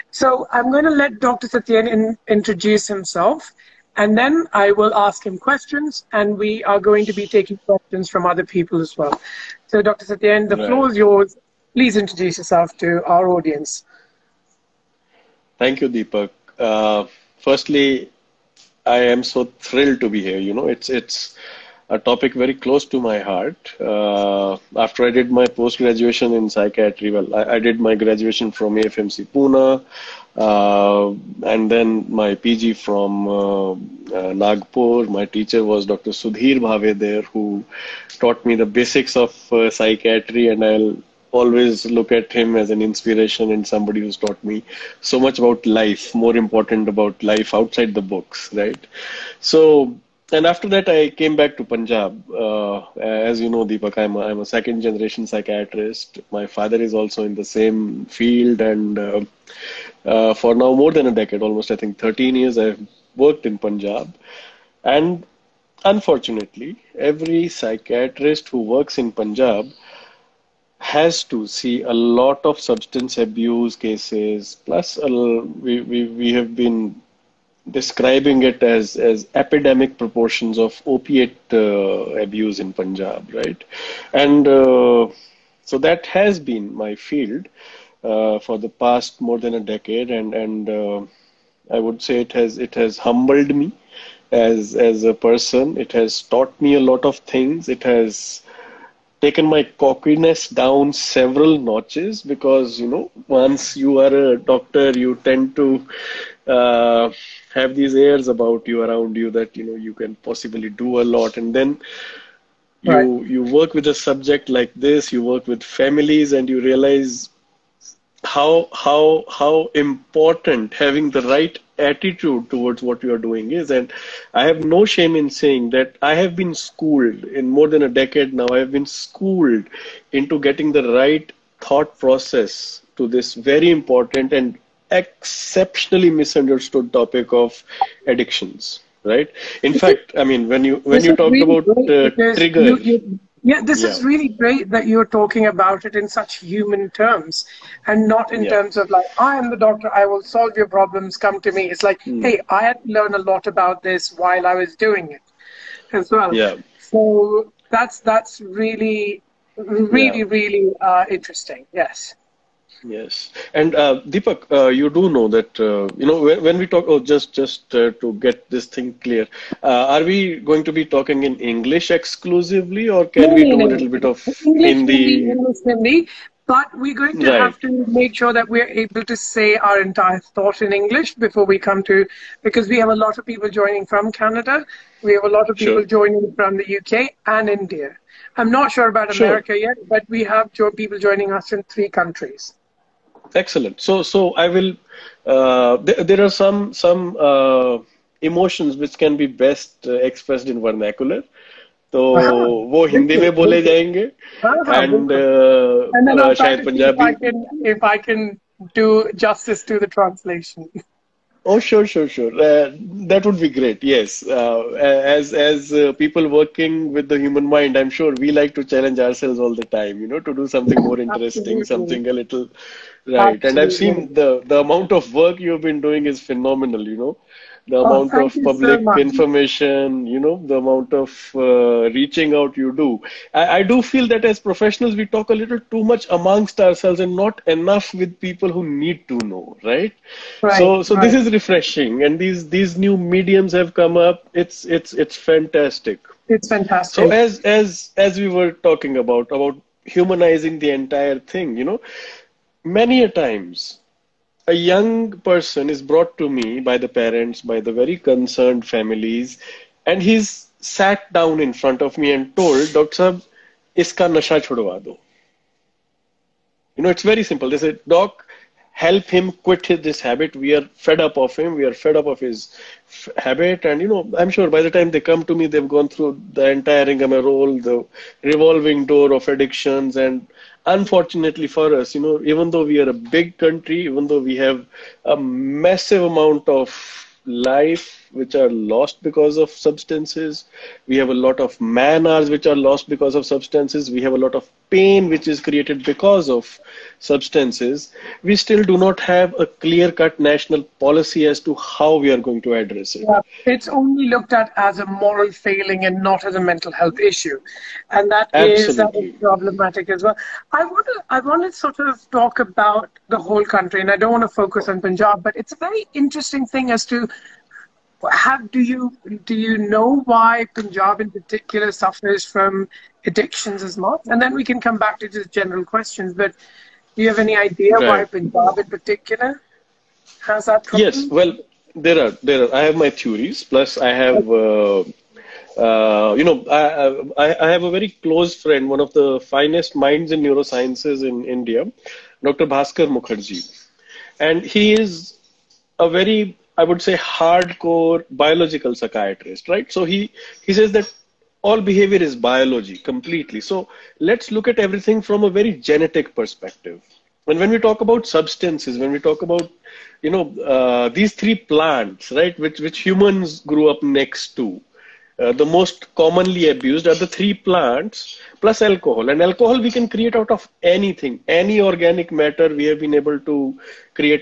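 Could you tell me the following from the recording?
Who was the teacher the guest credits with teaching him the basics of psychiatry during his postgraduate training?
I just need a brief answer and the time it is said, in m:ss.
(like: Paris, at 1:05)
Dr. Sudhir Bhave, at 0:35.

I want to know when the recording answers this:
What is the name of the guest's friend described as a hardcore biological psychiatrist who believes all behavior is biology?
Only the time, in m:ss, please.
5:42.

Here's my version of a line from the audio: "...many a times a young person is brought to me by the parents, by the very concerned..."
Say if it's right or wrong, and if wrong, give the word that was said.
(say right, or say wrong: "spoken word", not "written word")
right.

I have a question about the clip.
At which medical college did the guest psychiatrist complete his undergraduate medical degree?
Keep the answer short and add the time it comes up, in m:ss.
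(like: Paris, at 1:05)
AFMC Pune, at 0:28.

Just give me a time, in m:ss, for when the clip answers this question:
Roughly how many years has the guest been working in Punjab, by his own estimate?
1:01.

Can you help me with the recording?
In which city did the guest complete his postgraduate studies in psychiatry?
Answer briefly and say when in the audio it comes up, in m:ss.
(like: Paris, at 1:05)
Nagpur, at 0:34.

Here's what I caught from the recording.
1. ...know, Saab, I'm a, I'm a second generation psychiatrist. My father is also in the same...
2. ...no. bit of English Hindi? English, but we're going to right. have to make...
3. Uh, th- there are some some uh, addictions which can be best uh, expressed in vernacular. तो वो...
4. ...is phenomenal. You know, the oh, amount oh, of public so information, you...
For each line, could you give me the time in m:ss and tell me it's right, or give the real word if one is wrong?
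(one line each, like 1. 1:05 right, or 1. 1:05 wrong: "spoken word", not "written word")
1. 0:53 wrong: "Deepak", not "Saab"
2. 2:53 right
3. 3:15 wrong: "emotions", not "addictions"
4. 3:46 right.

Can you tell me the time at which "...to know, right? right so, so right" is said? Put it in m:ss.
3:59.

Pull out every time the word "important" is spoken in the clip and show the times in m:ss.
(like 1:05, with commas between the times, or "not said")
0:46, 1:59, 2:13.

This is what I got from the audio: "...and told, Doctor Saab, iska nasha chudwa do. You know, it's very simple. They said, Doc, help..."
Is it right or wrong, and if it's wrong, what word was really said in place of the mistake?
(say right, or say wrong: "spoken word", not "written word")
right.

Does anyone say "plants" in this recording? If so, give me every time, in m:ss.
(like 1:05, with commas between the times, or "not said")
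6:01, 6:07.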